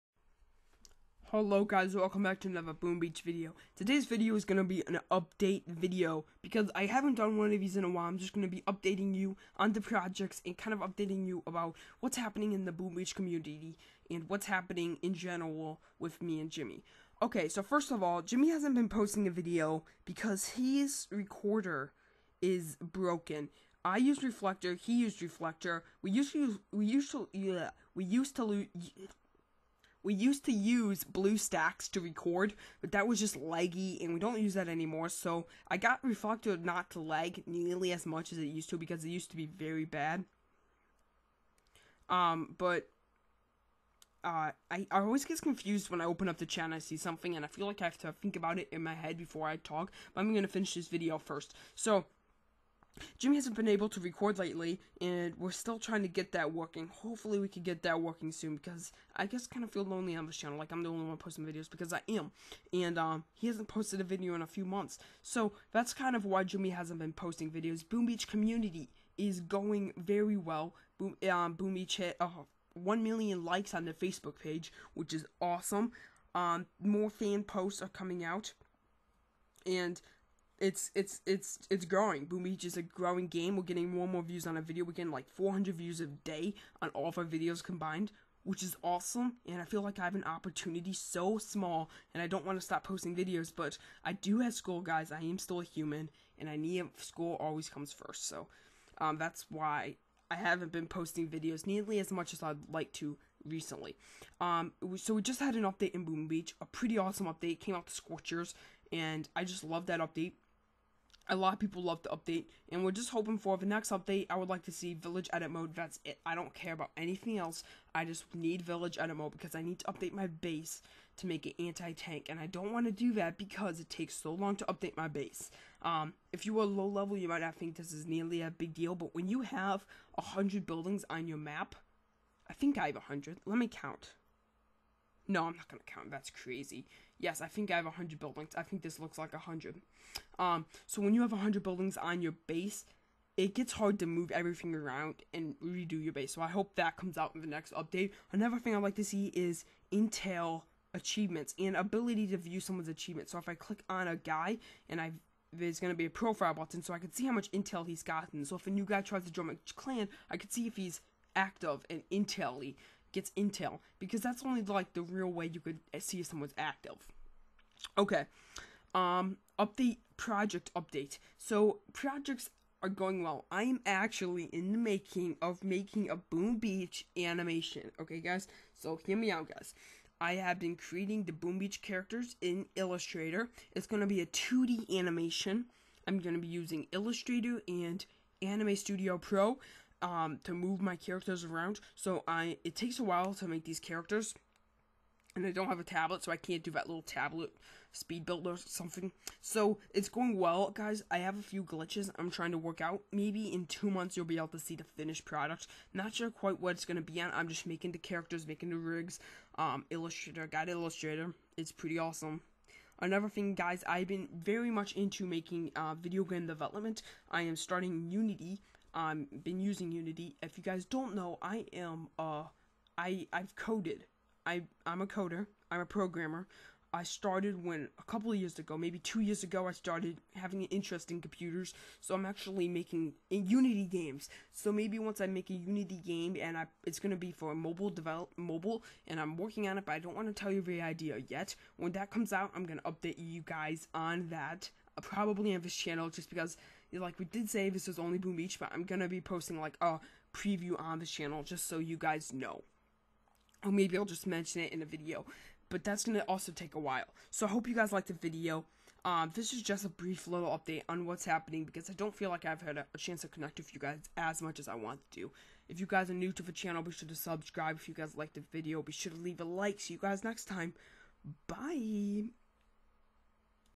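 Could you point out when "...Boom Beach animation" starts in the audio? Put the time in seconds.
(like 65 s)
176 s.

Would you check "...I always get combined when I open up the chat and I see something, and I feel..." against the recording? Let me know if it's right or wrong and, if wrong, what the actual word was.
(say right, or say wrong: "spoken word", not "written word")
wrong: "confused", not "combined".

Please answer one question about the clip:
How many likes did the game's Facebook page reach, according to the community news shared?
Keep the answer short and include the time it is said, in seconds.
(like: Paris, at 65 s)
1 million, at 72 s.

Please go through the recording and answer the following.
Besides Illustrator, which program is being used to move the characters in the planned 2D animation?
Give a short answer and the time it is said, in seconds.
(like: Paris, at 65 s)
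Anime Studio Pro, at 188 s.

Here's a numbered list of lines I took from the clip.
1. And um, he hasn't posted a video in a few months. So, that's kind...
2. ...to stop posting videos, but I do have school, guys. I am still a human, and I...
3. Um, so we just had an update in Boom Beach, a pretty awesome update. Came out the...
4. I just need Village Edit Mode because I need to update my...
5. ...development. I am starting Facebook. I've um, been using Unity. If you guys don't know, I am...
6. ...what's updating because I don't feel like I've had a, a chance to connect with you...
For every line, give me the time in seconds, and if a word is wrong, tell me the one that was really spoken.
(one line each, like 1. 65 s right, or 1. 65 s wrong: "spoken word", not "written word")
1. 62 s right
2. 92 s right
3. 104 s right
4. 117 s right
5. 216 s wrong: "Unity", not "Facebook"
6. 261 s wrong: "happening", not "updating".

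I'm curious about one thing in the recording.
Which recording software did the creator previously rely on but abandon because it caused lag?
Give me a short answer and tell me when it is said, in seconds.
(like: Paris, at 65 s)
BlueStacks, at 31 s.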